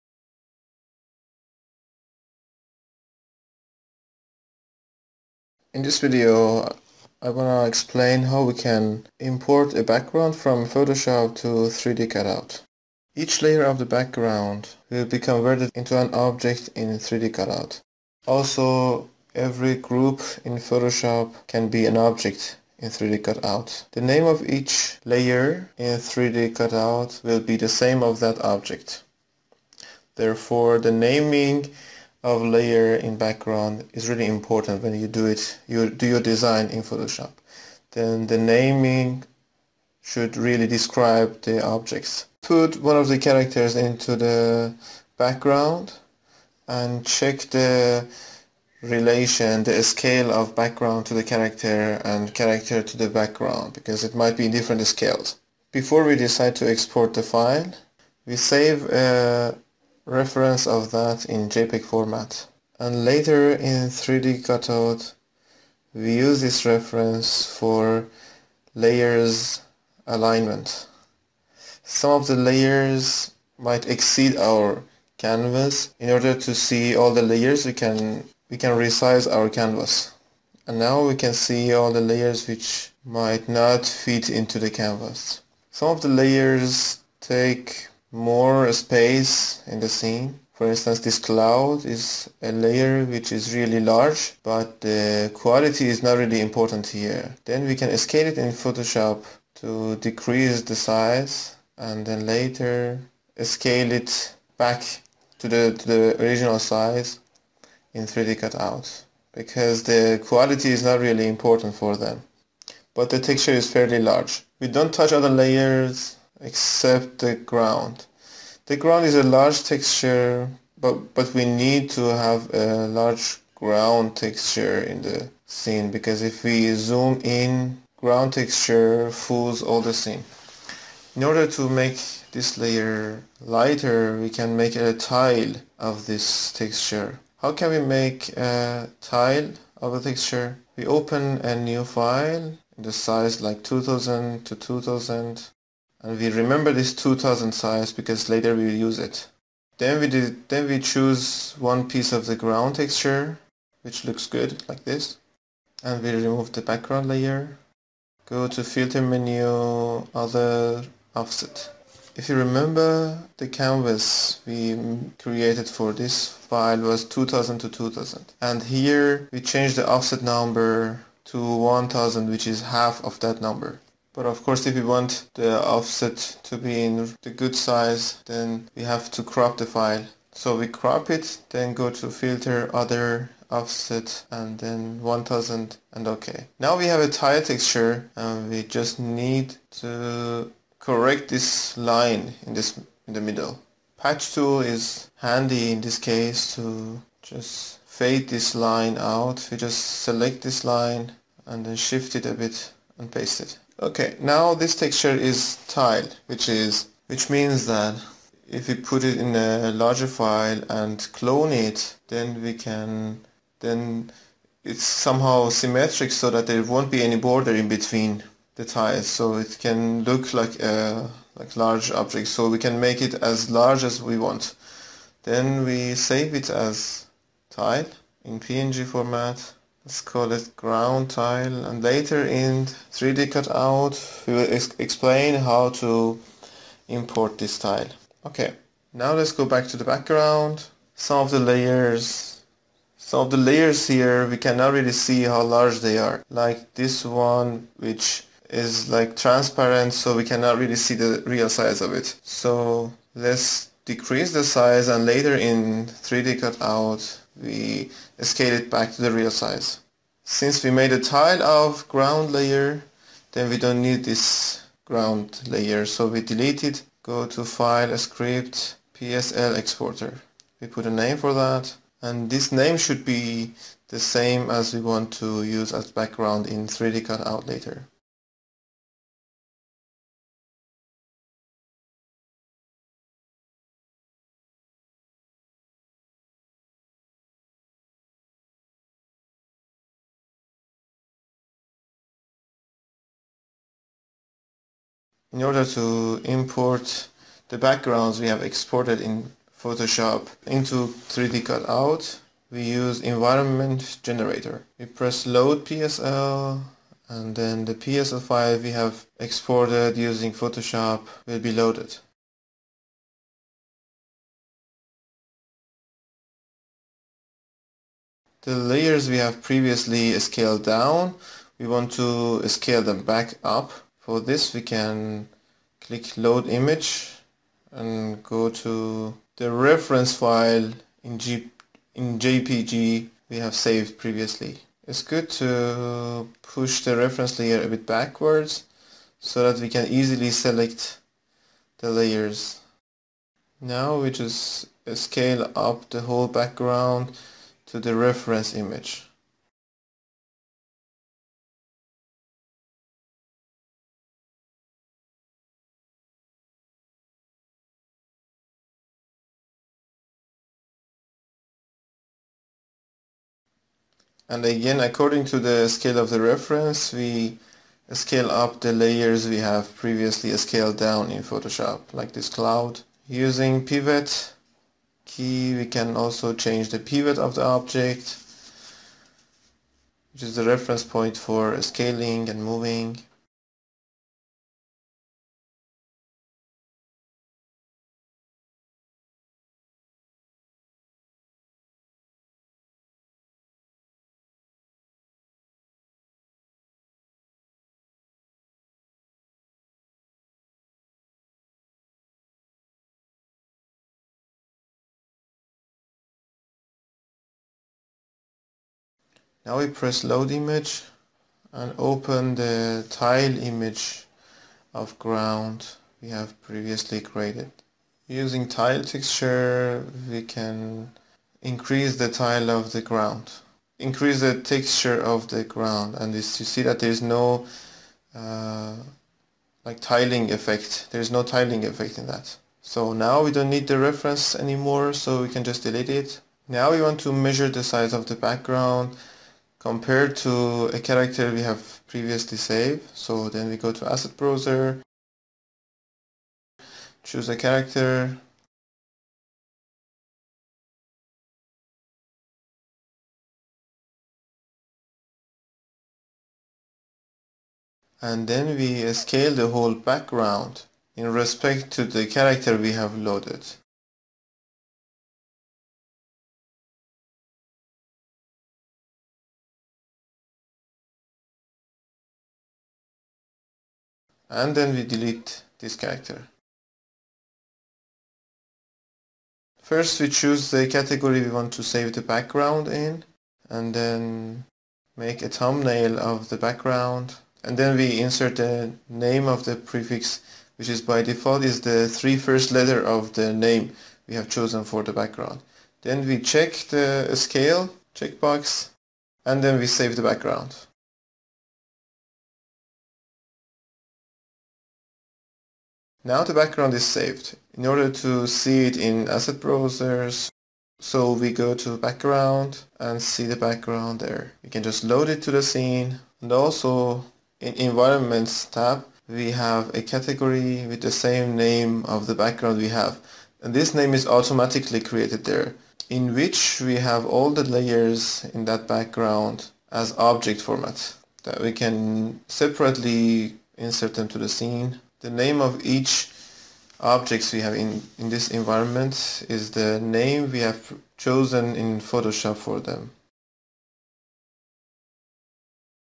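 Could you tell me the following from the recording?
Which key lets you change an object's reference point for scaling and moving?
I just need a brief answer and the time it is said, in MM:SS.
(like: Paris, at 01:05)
pivot key, at 06:13.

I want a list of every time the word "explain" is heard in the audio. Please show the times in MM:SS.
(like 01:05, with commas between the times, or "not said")
00:07, 03:54.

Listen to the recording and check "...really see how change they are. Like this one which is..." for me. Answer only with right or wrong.
wrong.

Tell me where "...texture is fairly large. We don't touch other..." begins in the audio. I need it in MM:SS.
01:53.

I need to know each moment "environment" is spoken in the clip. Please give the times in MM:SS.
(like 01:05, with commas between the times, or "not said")
05:02, 08:37, 08:58.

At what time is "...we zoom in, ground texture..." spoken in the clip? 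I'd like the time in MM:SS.
02:06.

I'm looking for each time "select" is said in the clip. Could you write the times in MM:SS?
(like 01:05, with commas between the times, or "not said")
03:20, 05:40.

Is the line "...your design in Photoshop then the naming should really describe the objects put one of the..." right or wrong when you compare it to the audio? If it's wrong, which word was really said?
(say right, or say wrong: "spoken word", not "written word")
right.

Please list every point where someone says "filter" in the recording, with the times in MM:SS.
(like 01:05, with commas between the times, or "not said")
02:38, 03:02.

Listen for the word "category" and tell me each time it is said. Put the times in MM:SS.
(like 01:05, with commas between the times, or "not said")
08:00, 08:39.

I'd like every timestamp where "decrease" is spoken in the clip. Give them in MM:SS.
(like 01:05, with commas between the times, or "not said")
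01:39, 04:13.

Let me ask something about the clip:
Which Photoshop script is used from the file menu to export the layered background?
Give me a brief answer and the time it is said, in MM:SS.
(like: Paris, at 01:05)
PSL exporter, at 04:28.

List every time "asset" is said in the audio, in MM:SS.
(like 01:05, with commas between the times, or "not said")
07:23, 08:29.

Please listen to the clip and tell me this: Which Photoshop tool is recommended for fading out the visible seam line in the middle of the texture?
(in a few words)
Patch tool.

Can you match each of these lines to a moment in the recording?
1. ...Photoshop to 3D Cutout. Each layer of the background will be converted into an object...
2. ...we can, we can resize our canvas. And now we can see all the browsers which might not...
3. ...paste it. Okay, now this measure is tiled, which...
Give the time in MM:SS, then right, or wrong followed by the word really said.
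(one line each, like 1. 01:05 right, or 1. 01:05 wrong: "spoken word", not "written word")
1. 00:10 right
2. 01:17 wrong: "layers", not "browsers"
3. 03:23 wrong: "texture", not "measure".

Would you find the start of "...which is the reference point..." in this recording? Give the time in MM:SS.
06:20.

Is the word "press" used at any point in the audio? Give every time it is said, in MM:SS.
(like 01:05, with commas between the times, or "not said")
05:04, 06:49.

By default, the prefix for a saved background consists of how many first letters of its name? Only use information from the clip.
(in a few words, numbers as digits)
3.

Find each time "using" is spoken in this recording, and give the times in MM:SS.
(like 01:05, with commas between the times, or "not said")
05:09, 06:13, 06:58.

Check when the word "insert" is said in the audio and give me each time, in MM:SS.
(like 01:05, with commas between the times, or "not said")
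08:07, 08:53.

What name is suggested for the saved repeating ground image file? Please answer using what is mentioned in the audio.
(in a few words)
ground tile.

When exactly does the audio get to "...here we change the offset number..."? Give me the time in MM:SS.
02:48.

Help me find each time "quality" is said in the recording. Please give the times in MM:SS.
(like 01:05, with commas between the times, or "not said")
01:35, 01:50.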